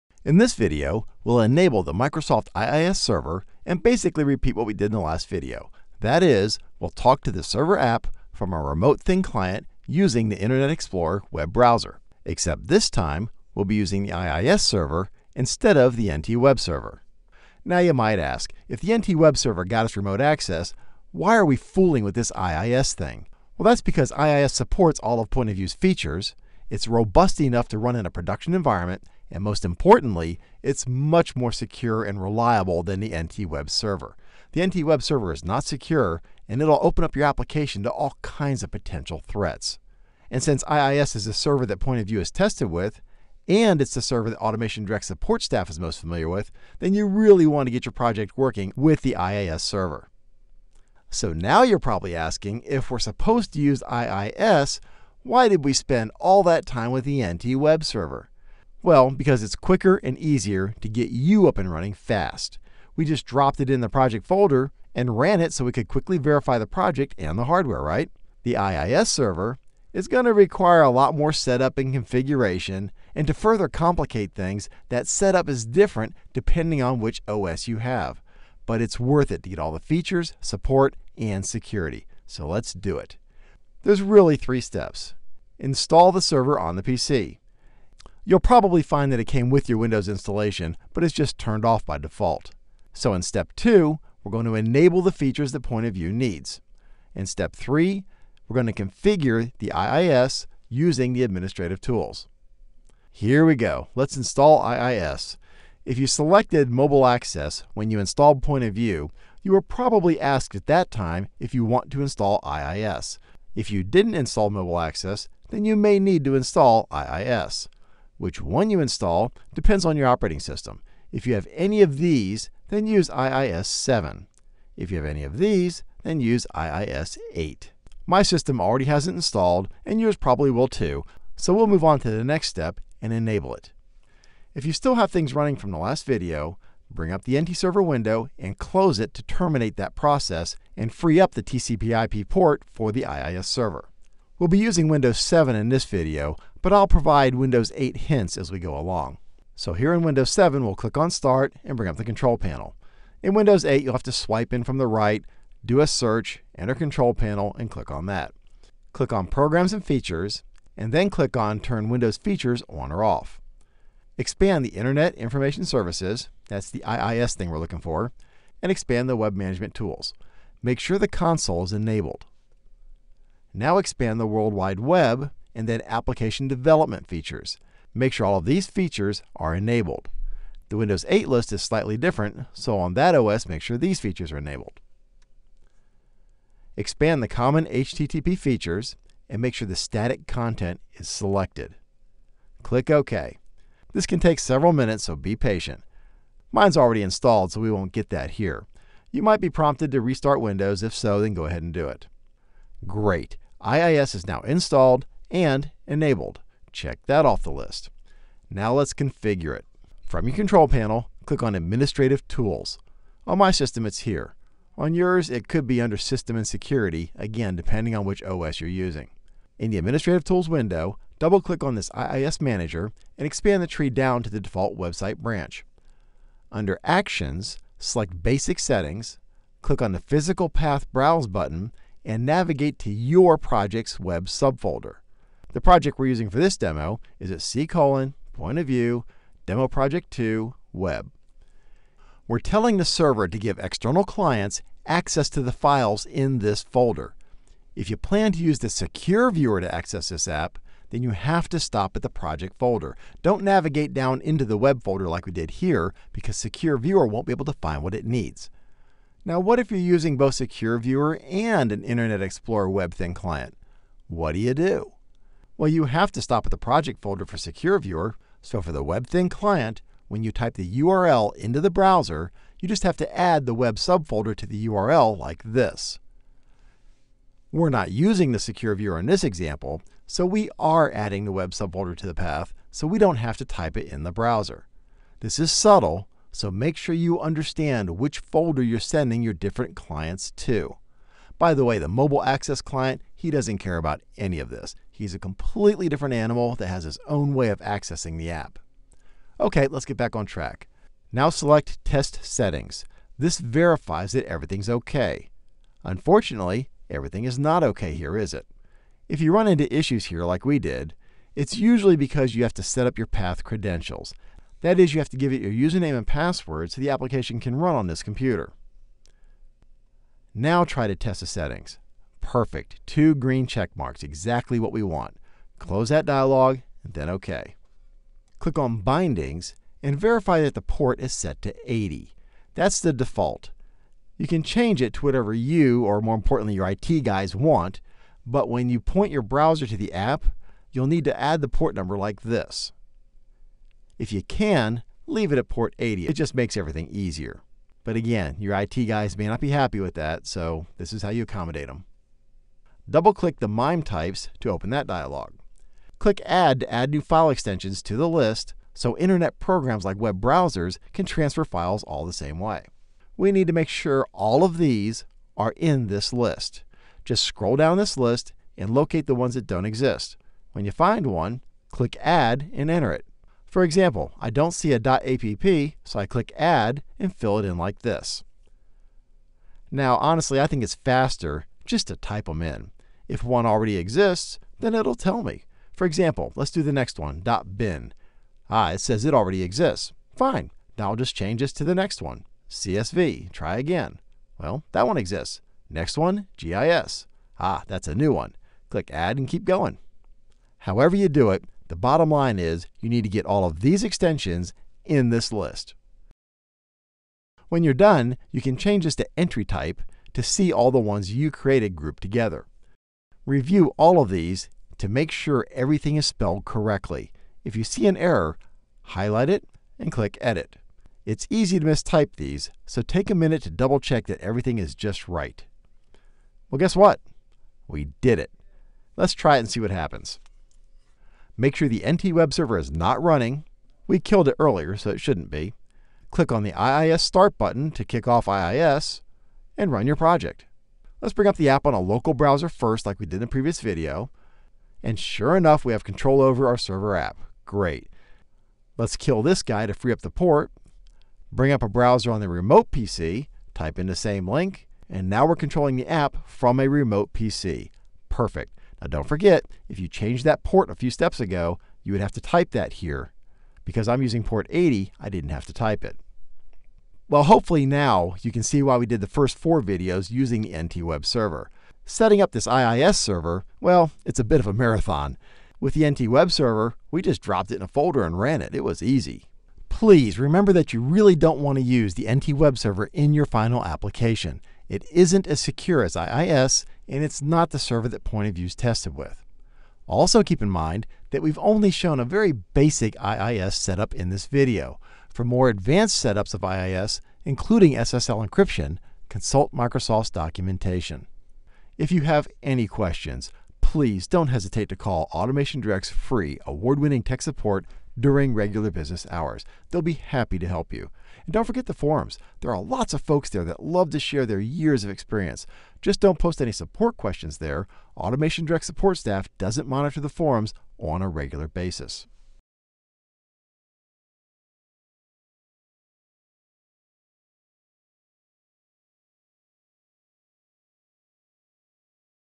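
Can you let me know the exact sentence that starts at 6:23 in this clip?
If one already exists, then it'll tell me.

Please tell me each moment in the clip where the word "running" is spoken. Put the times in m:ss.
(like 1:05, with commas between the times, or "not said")
1:01, 2:15, 7:13.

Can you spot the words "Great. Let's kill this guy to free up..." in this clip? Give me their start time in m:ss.
7:27.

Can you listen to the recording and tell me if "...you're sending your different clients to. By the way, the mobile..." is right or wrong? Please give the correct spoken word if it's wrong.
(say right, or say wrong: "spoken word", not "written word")
right.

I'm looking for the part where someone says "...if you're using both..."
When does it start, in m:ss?
4:19.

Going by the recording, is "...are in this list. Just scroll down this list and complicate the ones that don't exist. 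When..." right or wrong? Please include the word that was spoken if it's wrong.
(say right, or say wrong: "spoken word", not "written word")
wrong: "locate", not "complicate".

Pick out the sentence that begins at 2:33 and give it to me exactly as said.
In Windows 8, you'll have to swipe in from the right, do a search, enter Control Panel, and click on that.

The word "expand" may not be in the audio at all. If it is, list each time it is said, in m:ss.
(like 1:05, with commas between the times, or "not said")
2:44, 2:48, 2:53, 3:06, 3:43.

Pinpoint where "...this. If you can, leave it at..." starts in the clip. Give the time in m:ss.
5:42.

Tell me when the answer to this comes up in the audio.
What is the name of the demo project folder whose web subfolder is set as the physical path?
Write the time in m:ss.
3:59.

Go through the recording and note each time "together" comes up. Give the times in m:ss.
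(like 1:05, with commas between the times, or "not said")
6:52.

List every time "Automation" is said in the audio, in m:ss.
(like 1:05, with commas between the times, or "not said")
0:44, 8:25, 8:37.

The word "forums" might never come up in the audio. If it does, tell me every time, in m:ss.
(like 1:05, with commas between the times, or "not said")
8:31, 8:40.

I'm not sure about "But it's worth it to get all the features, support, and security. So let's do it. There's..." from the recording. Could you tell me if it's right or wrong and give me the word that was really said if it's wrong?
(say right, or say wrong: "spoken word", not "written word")
right.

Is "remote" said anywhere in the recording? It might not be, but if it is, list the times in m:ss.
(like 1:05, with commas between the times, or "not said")
0:08, 0:19, 7:32, 7:36.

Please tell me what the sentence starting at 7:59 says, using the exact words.
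Please remember that you really don't want to use the NT Web Server in your final application.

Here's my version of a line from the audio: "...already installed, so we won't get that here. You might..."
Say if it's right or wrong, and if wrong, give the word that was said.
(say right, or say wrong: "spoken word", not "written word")
right.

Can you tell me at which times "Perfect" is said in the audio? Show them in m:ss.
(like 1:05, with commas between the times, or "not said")
5:22, 7:38.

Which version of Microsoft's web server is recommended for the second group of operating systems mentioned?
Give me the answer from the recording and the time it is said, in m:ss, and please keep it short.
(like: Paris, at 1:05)
IIS 8, at 2:06.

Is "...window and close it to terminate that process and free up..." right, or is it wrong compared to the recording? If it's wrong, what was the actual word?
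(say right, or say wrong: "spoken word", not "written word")
right.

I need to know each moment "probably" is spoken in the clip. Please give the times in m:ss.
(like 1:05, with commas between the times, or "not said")
0:51, 1:28, 1:49, 2:10.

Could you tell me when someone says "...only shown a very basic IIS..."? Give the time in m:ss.
8:11.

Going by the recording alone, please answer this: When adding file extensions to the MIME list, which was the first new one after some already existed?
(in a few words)
GIS.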